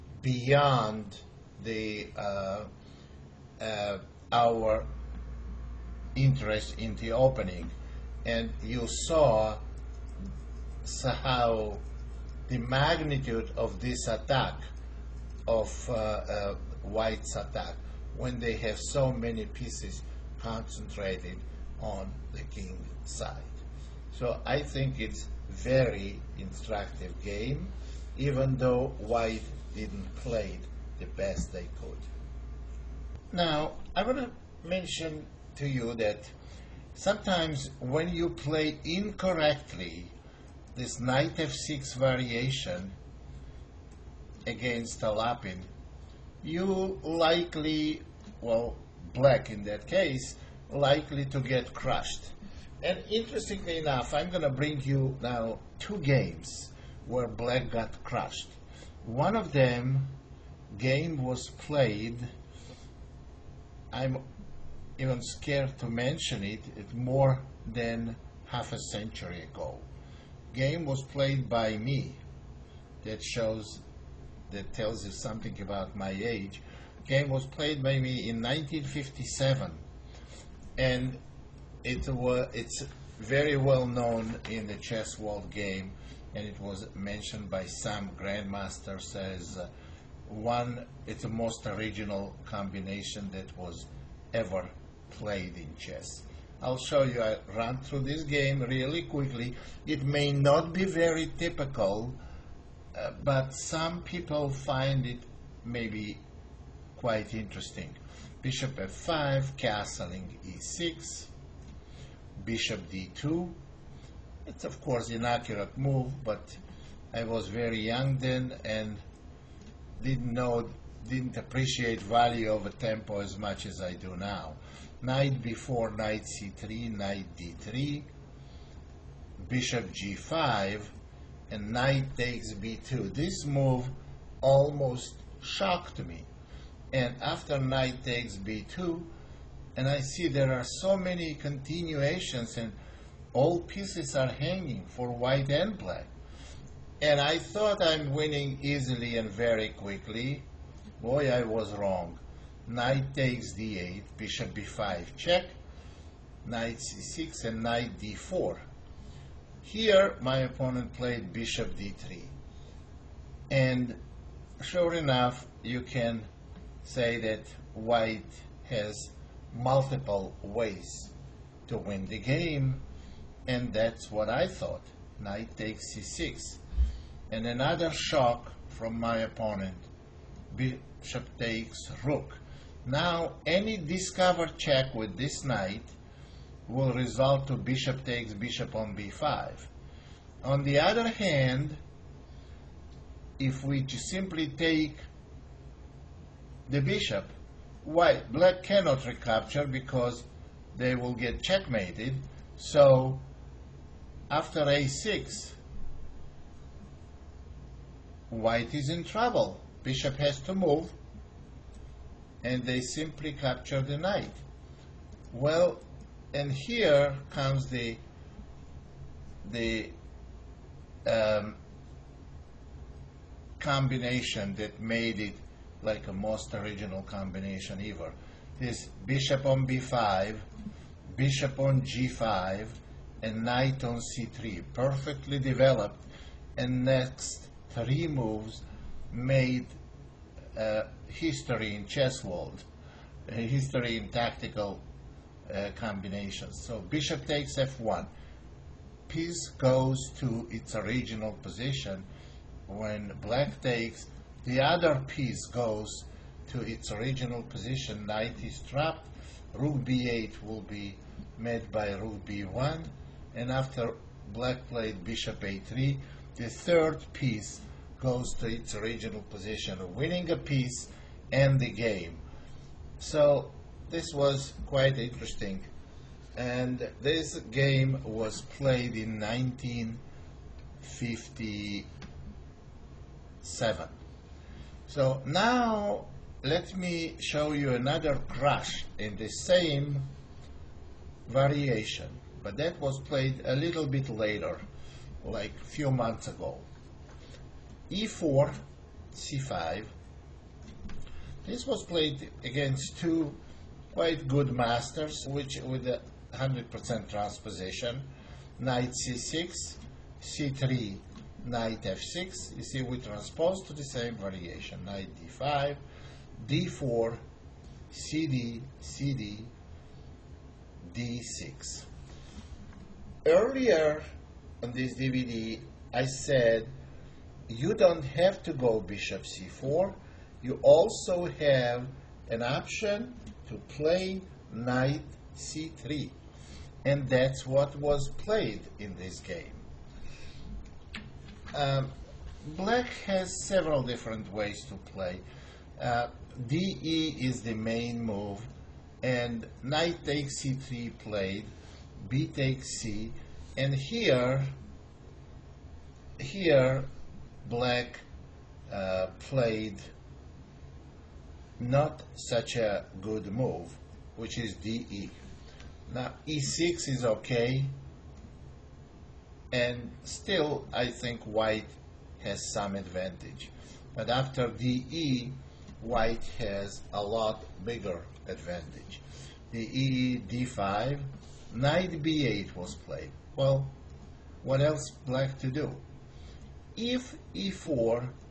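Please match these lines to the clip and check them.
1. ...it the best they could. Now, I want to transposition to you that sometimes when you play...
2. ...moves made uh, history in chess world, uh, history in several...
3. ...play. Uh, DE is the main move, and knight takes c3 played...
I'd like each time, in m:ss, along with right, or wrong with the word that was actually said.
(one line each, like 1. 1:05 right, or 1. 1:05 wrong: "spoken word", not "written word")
1. 0:30 wrong: "mention", not "transposition"
2. 3:58 wrong: "tactical", not "several"
3. 5:44 right.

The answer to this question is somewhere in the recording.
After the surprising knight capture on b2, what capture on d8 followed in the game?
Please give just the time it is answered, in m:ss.
2:32.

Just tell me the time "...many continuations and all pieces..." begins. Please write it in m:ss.
2:20.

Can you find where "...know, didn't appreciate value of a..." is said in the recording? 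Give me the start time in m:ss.
2:00.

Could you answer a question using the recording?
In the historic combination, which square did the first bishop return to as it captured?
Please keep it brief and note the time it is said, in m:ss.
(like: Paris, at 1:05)
f1, at 4:07.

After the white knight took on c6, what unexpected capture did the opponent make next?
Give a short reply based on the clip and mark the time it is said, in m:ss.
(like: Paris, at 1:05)
Bishop takes rook, at 3:00.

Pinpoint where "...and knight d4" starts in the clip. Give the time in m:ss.
2:37.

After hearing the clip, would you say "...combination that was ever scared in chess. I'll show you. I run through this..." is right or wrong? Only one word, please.
wrong.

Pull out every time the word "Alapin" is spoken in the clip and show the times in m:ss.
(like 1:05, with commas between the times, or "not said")
0:45.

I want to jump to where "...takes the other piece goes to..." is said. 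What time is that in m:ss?
4:13.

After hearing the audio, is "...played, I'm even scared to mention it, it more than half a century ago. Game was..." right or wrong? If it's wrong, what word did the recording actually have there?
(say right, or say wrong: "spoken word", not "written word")
right.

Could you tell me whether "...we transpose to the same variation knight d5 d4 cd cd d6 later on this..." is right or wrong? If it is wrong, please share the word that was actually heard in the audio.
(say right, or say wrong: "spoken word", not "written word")
wrong: "earlier", not "later".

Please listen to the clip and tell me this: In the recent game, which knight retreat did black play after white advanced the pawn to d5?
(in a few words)
Knight b8.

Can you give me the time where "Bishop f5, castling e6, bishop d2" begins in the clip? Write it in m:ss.
1:48.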